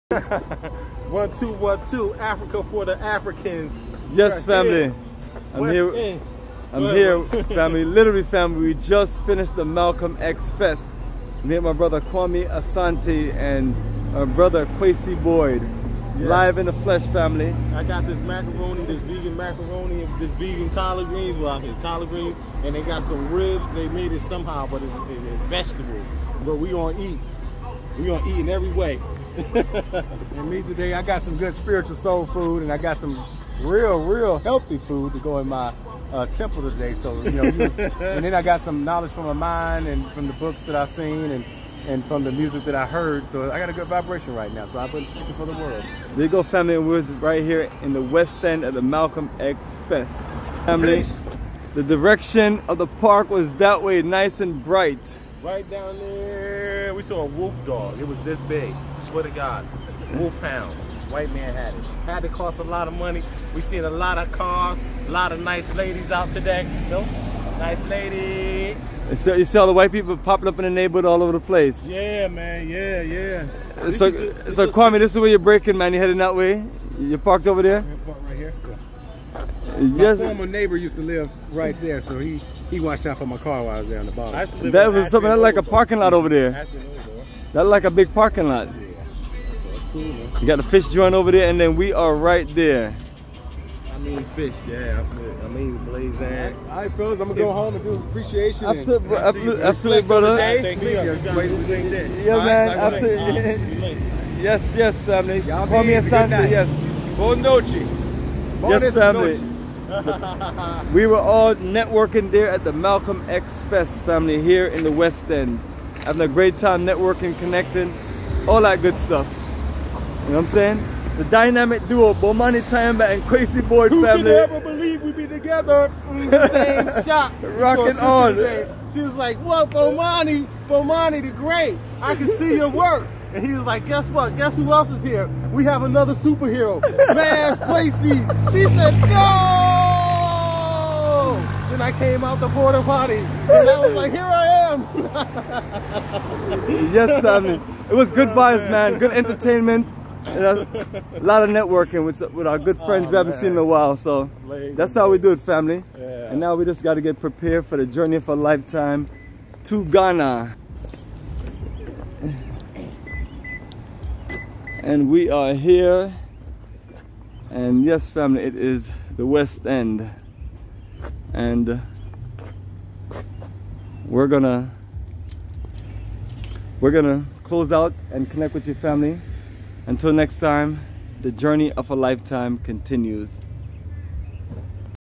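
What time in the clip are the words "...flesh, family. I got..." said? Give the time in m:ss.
0:16.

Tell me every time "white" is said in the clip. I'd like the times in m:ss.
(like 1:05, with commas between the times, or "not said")
1:01, 1:09.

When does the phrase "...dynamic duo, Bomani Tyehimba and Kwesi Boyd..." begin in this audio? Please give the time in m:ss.
2:01.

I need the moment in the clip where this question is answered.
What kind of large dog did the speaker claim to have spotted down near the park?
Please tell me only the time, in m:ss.
1:00.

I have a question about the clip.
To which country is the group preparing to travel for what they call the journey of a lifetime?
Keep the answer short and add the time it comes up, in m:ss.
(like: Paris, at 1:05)
Ghana, at 2:39.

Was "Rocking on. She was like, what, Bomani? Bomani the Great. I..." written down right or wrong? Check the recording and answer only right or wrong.
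right.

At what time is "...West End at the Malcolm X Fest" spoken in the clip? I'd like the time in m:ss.
0:48.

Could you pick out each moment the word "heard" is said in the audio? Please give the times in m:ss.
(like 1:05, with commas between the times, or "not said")
0:42.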